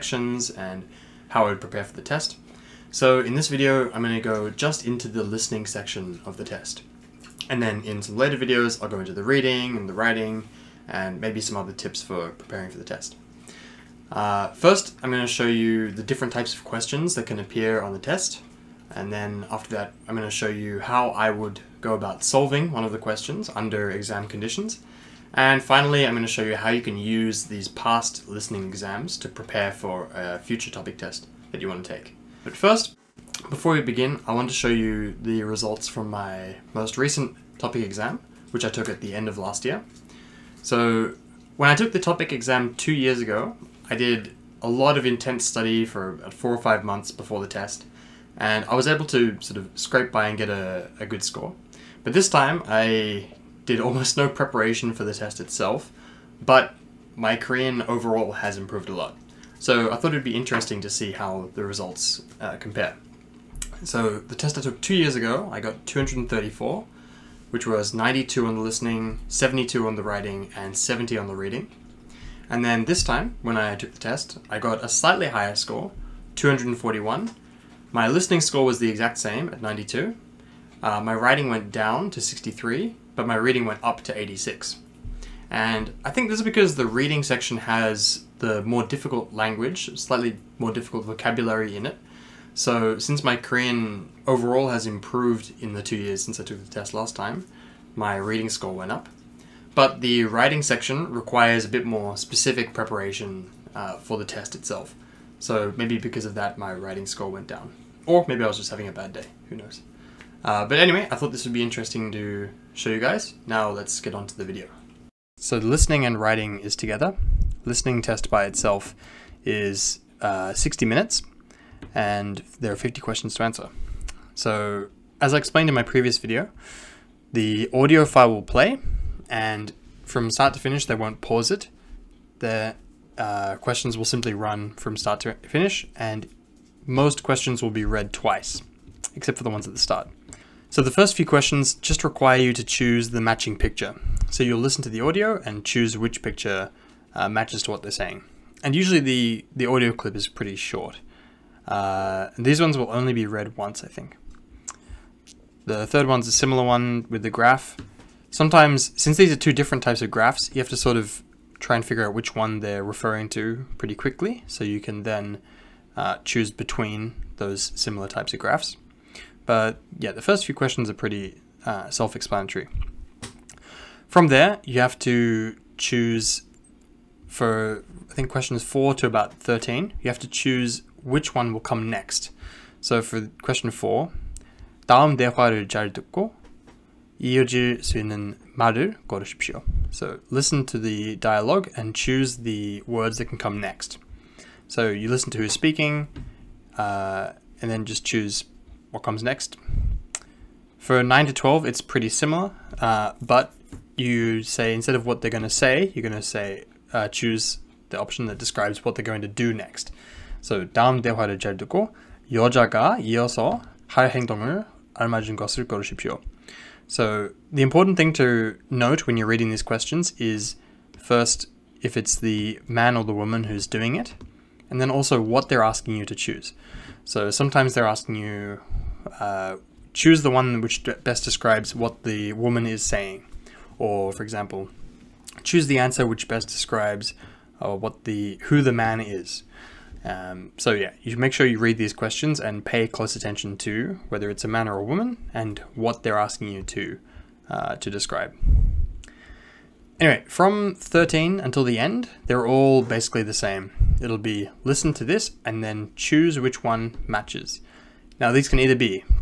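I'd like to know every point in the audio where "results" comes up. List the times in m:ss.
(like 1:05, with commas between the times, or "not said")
0:35, 1:01.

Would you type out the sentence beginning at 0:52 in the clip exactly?
But this time I did almost no preparation for the test itself, but my Korean overall has improved a lot.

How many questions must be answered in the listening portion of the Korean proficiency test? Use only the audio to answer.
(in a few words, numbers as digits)
50.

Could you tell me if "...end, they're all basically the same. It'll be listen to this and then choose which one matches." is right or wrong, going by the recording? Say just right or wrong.
right.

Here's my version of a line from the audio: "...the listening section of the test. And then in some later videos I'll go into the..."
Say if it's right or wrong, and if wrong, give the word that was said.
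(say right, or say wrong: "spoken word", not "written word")
right.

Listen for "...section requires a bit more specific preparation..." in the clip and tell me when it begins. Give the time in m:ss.
1:40.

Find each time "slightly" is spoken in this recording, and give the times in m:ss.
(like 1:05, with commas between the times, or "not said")
1:14, 1:29.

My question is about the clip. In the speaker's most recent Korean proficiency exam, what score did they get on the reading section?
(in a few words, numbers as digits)
86.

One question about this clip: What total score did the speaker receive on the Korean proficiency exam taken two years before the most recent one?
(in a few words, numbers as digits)
234.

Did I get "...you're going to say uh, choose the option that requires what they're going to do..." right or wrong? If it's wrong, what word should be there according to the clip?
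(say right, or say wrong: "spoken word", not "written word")
wrong: "describes", not "requires".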